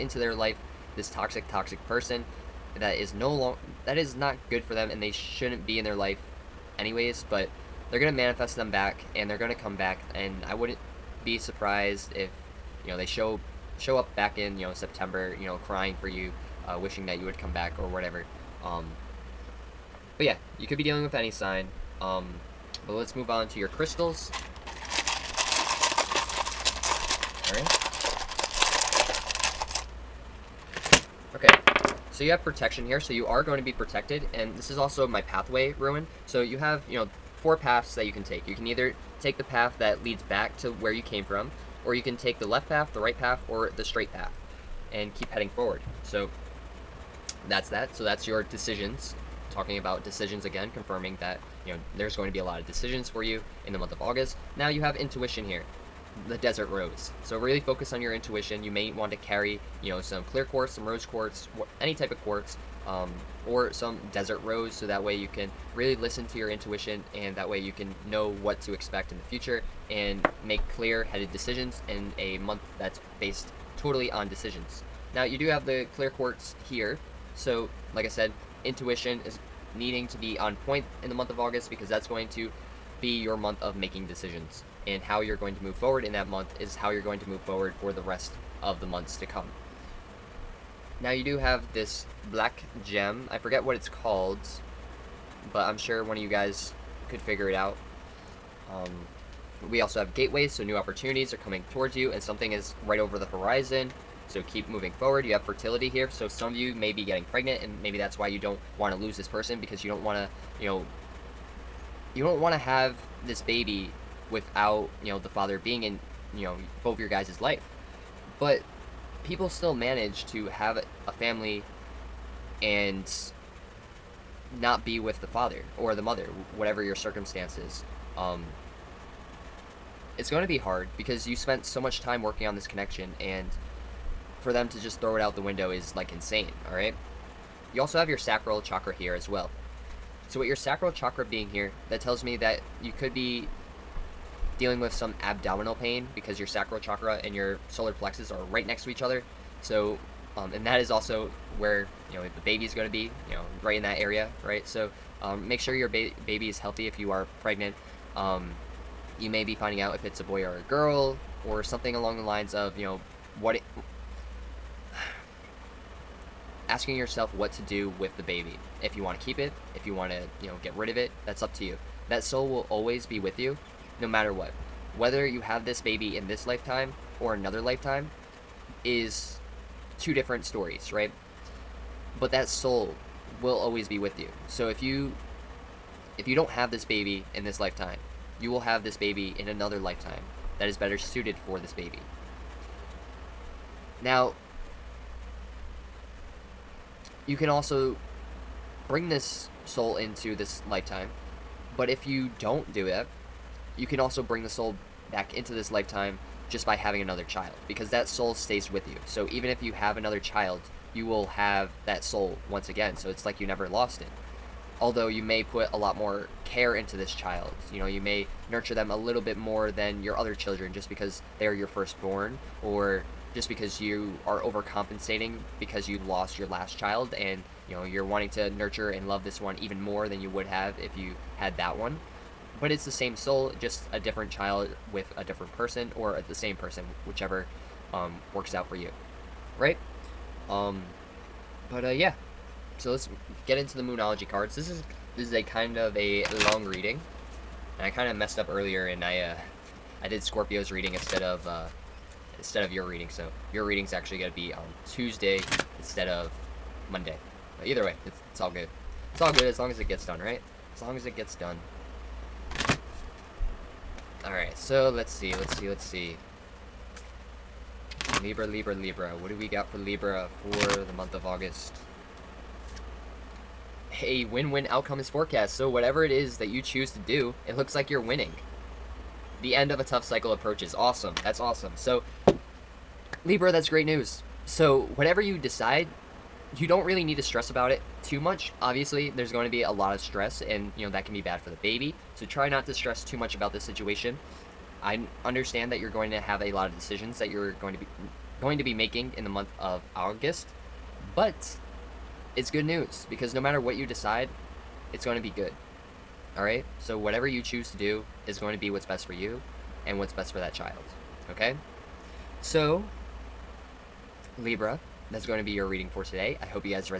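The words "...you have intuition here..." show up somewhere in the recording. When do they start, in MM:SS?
00:54.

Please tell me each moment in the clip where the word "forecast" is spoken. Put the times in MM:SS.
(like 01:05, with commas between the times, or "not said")
04:35.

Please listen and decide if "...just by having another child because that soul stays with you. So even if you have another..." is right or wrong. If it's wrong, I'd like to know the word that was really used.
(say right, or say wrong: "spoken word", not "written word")
right.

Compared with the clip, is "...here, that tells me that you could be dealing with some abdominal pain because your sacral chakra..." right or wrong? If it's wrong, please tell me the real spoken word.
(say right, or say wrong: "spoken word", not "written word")
right.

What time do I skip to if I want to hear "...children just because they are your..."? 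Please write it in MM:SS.
03:40.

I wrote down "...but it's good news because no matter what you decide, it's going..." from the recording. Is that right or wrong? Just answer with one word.
right.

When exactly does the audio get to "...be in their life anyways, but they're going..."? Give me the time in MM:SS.
00:05.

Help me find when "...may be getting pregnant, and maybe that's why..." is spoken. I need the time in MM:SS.
01:46.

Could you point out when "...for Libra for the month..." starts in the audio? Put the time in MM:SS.
04:29.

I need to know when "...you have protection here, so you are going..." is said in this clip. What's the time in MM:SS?
00:32.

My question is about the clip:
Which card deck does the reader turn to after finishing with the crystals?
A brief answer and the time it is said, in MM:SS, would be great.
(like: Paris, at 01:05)
Moonology cards, at 04:03.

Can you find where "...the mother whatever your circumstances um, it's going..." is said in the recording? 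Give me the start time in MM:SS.
02:05.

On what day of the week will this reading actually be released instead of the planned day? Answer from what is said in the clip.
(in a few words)
Tuesday.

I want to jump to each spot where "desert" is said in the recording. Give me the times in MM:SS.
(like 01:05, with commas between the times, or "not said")
00:56, 01:04.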